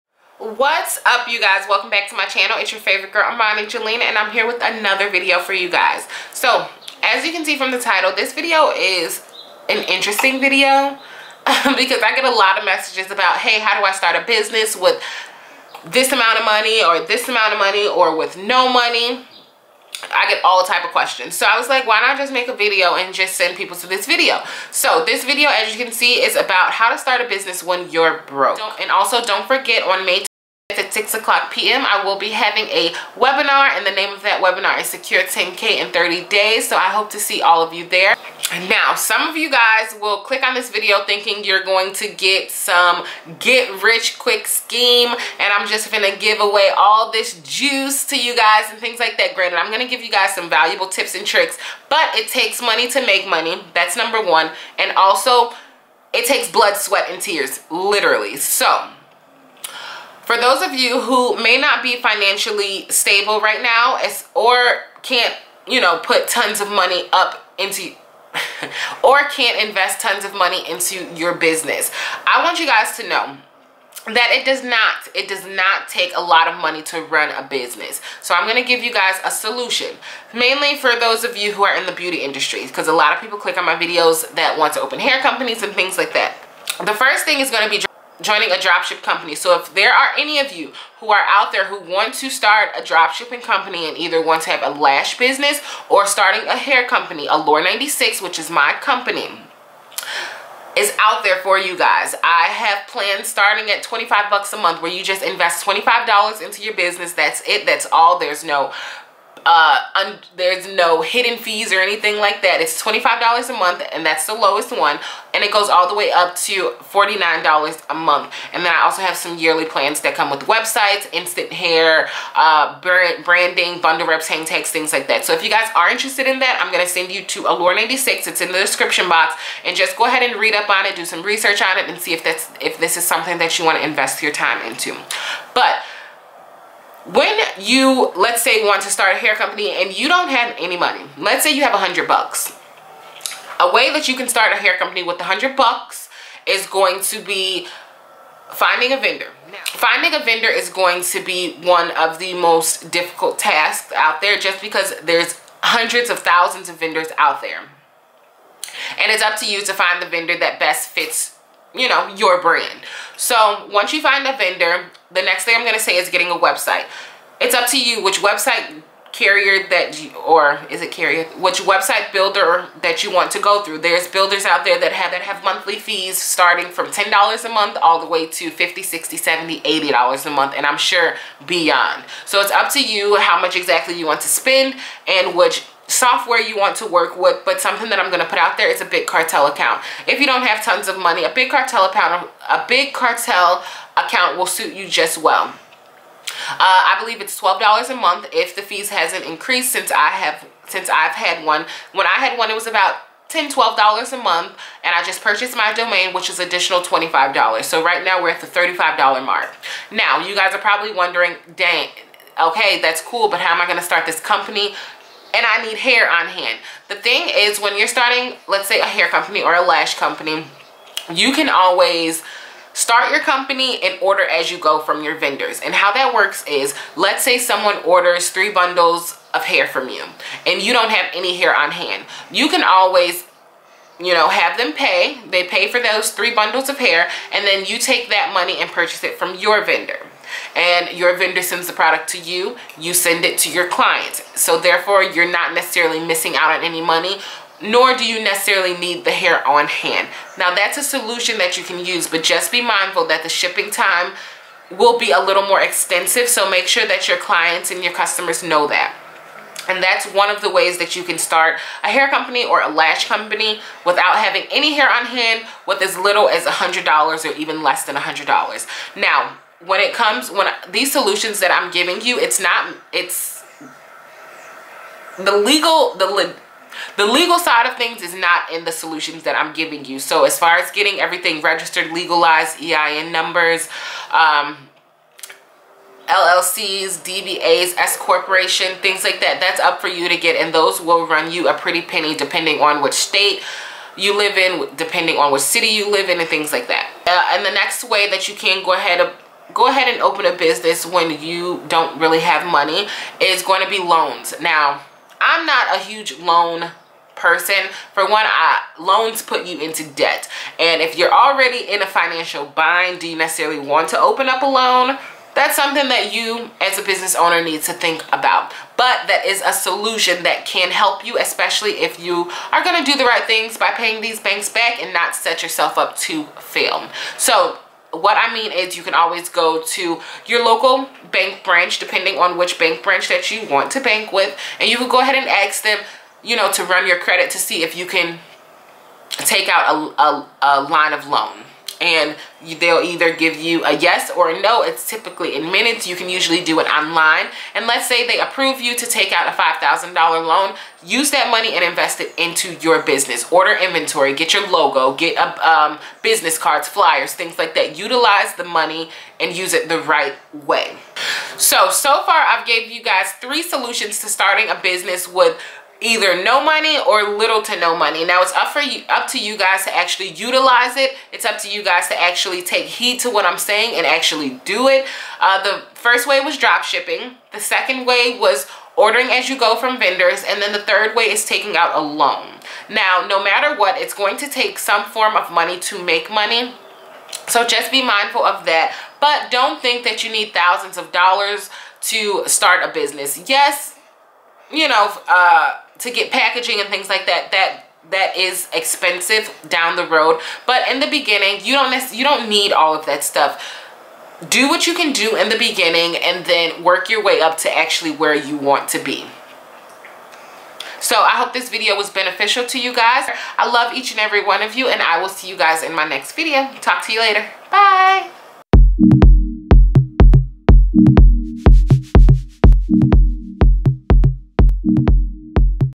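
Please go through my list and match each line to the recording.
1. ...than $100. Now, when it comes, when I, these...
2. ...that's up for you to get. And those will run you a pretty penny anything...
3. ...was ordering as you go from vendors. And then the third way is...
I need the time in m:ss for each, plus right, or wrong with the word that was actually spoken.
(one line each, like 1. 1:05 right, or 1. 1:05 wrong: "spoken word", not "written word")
1. 4:27 right
2. 4:49 wrong: "depending", not "anything"
3. 6:18 right.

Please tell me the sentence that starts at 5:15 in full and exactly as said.
That's something that you as a business owner needs to think about.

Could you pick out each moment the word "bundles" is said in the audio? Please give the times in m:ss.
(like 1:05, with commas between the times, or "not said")
2:03, 3:48, 3:56.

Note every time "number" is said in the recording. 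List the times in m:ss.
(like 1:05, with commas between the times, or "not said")
0:53, 4:43.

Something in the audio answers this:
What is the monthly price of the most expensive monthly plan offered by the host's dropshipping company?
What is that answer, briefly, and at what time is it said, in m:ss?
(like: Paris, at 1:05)
$49, at 1:56.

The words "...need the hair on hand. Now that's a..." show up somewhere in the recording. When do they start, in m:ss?
4:08.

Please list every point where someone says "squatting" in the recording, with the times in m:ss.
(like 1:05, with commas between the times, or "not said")
not said.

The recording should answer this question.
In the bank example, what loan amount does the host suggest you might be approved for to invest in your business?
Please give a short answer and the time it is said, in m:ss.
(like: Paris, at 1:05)
$5,000, at 5:49.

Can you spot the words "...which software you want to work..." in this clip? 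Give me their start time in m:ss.
3:05.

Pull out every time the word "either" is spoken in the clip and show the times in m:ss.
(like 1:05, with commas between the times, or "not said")
1:33, 5:42, 6:05.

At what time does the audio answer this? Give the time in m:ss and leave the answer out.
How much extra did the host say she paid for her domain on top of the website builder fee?
3:26.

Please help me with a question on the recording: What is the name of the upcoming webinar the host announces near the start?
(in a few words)
Secure 10K in 30 Days.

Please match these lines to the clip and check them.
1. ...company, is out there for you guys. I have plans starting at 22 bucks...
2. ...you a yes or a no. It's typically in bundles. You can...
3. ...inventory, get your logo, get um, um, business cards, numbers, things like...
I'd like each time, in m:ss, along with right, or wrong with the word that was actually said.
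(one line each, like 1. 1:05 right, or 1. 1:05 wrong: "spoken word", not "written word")
1. 1:38 wrong: "25", not "22"
2. 5:43 wrong: "minutes", not "bundles"
3. 5:53 wrong: "flyers", not "numbers".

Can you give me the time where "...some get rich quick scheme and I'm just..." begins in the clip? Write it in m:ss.
0:42.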